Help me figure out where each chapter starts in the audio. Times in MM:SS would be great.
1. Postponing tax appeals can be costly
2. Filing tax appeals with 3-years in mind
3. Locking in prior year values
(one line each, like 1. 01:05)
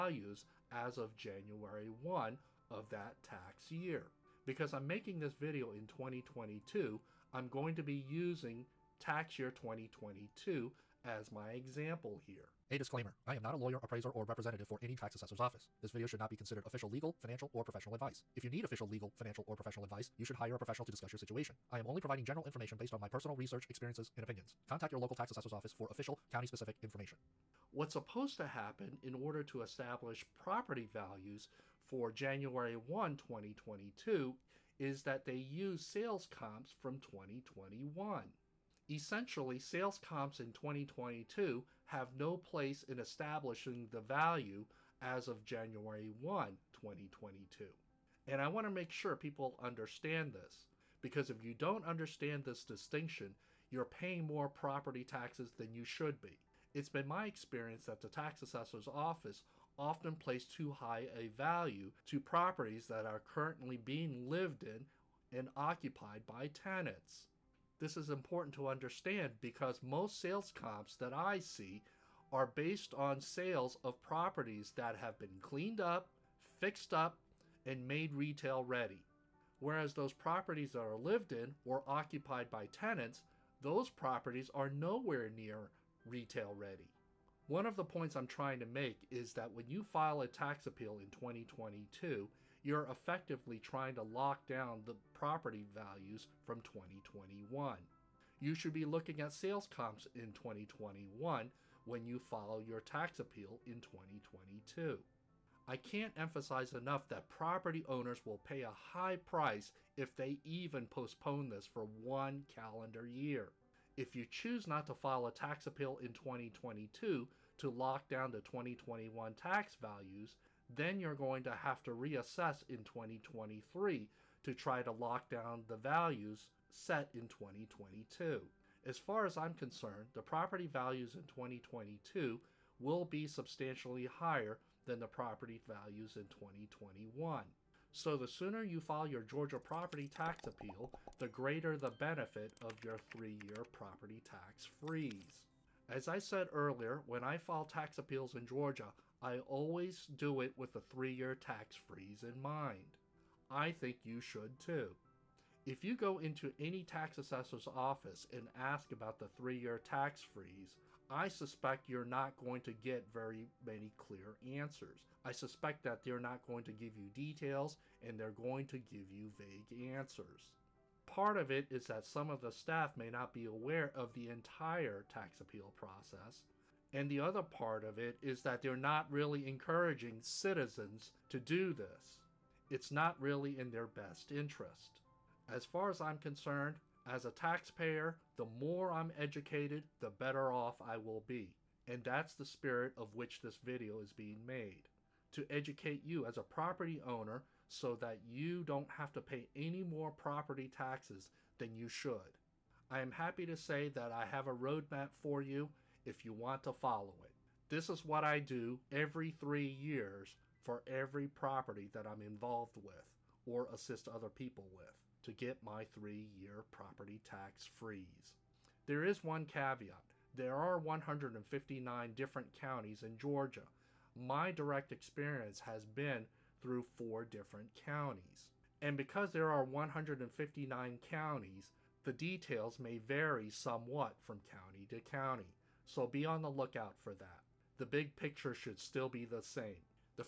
1. 01:44
2. 02:24
3. 01:26.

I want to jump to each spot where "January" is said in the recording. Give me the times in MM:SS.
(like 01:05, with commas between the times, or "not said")
00:01, 00:32, 00:45.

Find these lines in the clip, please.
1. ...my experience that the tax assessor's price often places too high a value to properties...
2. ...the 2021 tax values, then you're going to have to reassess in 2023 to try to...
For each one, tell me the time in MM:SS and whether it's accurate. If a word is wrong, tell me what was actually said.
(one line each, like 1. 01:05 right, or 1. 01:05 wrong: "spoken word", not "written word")
1. 00:57 wrong: "office", not "price"
2. 01:58 right.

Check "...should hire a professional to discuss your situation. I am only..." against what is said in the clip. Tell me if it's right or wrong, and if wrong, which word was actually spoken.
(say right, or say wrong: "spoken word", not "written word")
right.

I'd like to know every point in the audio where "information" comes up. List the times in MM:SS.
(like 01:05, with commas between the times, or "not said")
00:22, 00:26.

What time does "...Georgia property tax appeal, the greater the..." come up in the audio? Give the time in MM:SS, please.
02:19.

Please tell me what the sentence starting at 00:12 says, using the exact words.
A disclaimer, I am not a lawyer, appraiser, or representative for any tax assessor's office.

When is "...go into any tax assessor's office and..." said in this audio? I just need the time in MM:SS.
02:35.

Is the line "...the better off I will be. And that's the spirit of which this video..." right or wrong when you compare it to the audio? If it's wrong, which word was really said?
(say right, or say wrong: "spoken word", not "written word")
right.